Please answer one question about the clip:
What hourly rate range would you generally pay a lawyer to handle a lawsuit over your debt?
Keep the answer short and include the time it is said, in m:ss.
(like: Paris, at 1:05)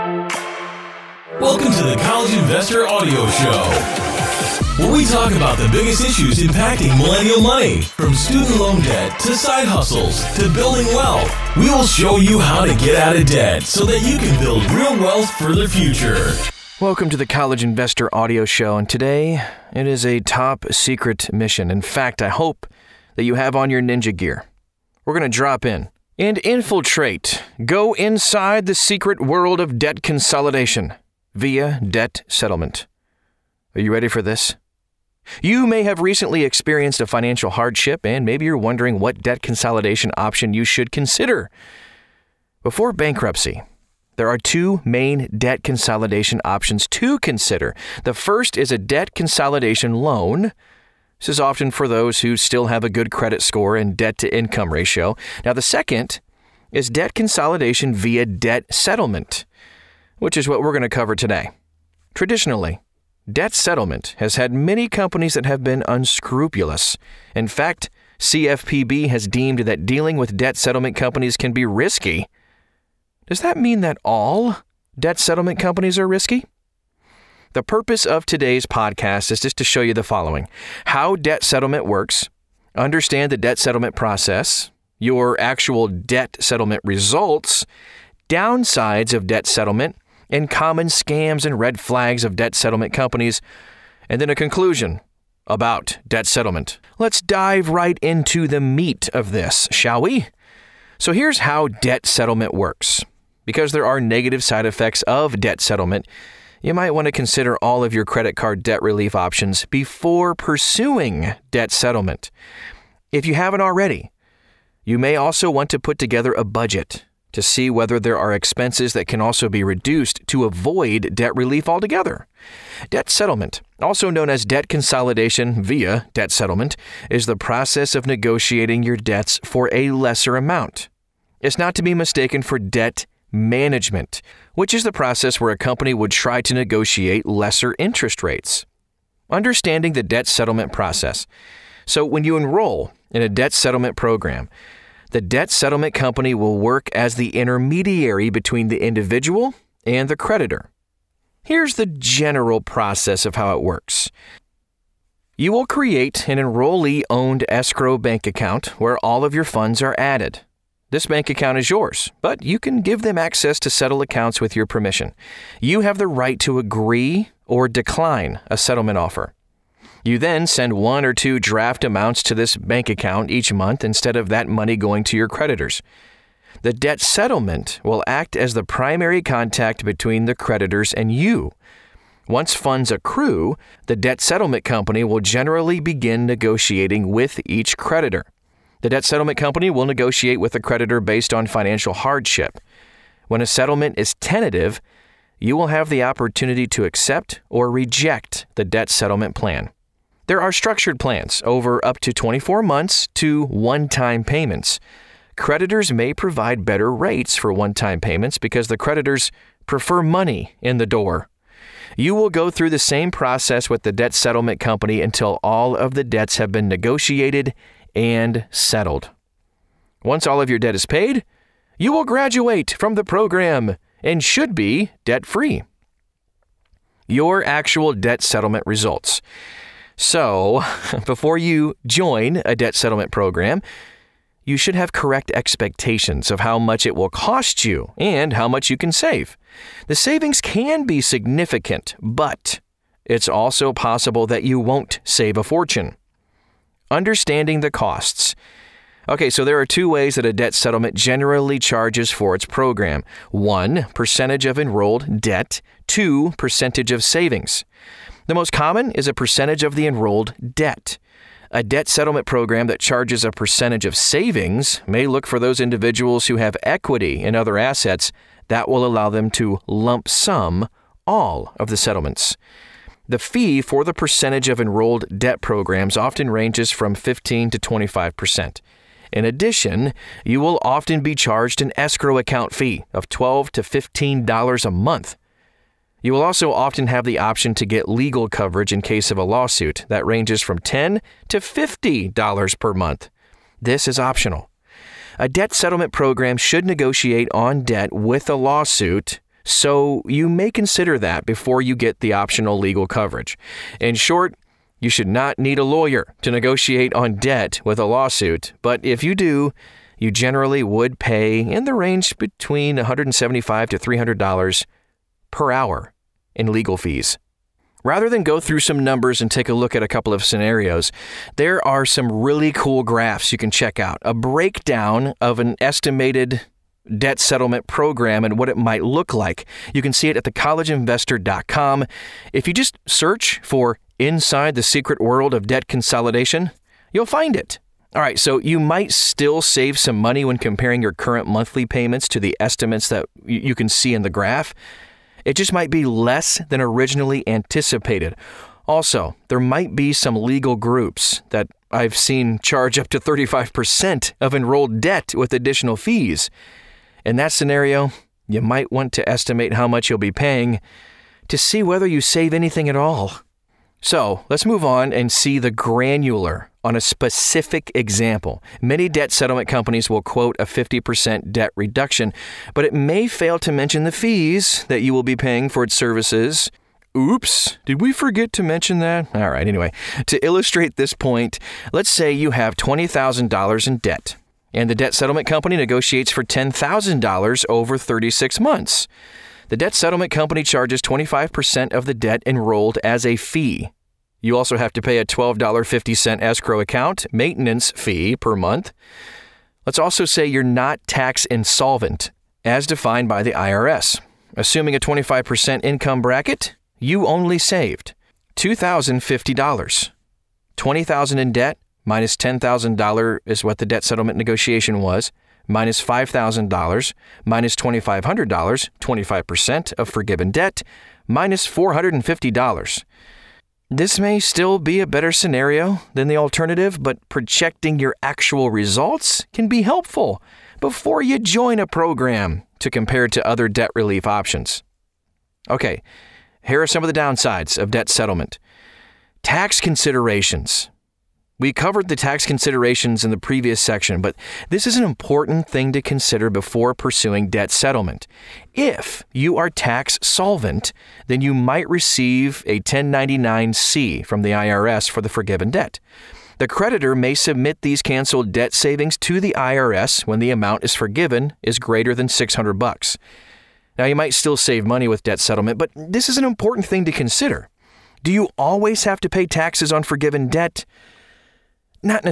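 $175 to $300, at 5:12.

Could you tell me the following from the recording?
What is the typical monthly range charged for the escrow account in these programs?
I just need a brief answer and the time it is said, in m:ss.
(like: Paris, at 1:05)
$12 to $15, at 4:43.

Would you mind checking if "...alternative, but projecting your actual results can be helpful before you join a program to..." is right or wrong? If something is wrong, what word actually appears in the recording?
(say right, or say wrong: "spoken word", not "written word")
right.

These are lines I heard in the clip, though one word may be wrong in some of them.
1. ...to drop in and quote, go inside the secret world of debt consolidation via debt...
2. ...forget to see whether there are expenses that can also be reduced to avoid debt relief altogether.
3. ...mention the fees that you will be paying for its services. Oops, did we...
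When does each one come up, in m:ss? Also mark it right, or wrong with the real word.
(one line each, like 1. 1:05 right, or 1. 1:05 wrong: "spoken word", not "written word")
1. 0:25 wrong: "infiltrate", not "quote"
2. 1:56 wrong: "budget", not "forget"
3. 6:13 right.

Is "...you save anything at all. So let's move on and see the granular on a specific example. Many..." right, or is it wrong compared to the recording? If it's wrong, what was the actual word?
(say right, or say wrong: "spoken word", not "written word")
right.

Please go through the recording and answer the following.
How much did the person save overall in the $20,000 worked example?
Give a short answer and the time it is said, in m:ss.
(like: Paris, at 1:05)
$2,050, at 6:48.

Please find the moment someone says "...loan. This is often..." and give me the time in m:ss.
0:49.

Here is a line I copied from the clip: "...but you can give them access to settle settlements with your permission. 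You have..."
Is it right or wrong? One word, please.
wrong.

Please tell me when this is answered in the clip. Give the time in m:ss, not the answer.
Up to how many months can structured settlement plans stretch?
3:22.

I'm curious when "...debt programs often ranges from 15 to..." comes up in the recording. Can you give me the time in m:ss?
4:35.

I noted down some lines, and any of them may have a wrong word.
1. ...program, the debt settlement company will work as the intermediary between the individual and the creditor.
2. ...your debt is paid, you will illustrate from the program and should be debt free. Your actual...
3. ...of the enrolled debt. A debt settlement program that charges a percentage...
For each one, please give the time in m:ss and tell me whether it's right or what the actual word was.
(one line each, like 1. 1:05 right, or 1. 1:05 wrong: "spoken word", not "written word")
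1. 2:23 right
2. 3:40 wrong: "graduate", not "illustrate"
3. 4:19 right.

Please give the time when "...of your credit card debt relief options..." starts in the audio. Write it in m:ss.
1:47.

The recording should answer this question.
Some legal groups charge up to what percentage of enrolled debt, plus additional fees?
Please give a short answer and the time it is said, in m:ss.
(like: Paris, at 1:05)
35%, at 5:52.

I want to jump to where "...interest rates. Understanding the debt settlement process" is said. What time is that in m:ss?
2:17.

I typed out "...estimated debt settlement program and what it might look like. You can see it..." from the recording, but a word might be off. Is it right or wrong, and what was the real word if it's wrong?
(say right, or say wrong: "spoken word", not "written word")
right.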